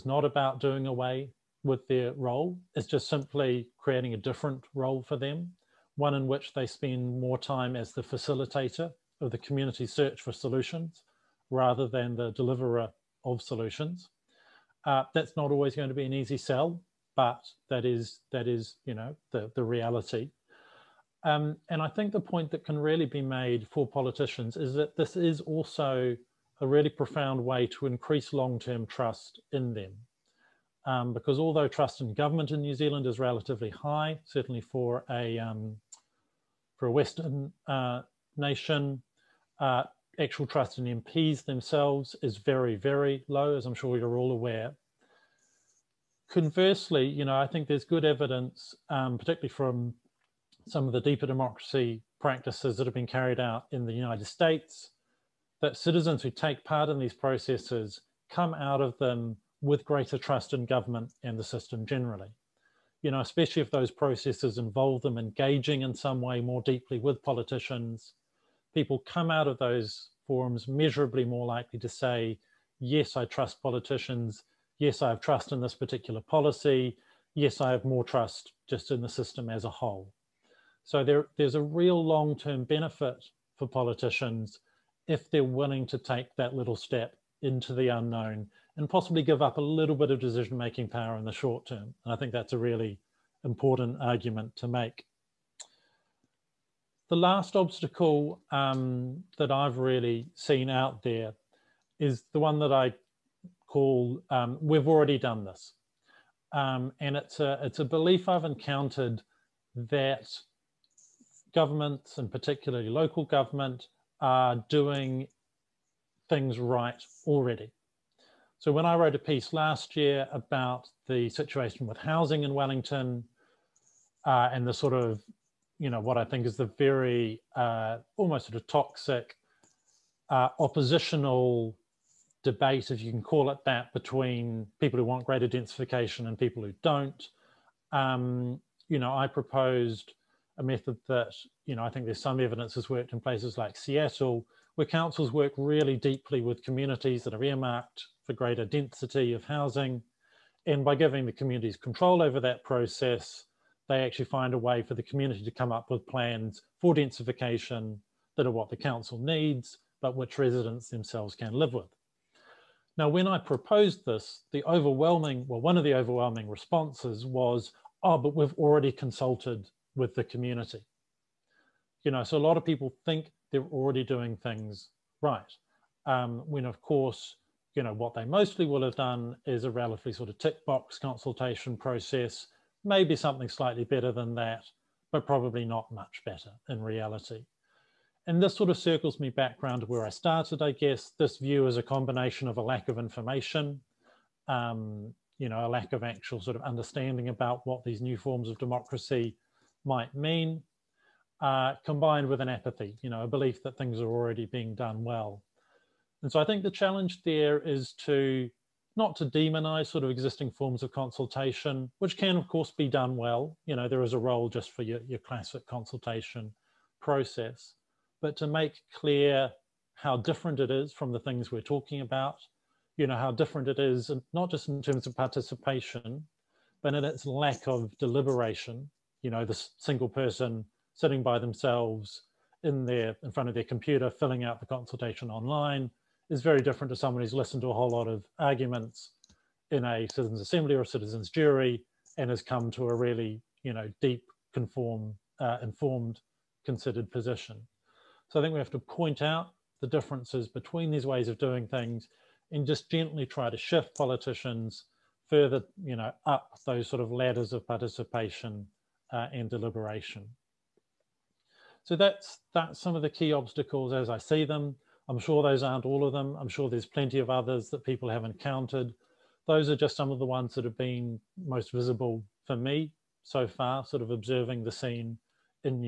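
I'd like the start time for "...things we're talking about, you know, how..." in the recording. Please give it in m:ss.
3:41.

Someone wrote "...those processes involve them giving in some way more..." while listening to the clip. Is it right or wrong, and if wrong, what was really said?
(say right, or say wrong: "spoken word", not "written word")
wrong: "engaging", not "giving".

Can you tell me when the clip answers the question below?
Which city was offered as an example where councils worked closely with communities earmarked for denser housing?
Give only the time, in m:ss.
2:23.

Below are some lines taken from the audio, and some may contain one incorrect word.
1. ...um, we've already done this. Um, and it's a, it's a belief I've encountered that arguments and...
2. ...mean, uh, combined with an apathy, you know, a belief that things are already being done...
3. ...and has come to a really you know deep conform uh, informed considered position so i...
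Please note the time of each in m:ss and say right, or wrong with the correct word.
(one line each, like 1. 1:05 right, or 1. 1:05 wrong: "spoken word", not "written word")
1. 1:44 wrong: "governments", not "arguments"
2. 3:20 right
3. 4:02 right.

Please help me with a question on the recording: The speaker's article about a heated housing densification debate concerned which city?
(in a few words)
Wellington.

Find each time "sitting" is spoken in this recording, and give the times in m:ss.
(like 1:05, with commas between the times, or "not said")
3:50.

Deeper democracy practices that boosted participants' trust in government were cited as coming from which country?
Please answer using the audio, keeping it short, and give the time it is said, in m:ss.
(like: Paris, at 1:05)
United States, at 0:53.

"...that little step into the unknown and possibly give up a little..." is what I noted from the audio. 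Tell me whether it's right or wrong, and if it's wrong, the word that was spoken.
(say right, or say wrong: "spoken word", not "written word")
right.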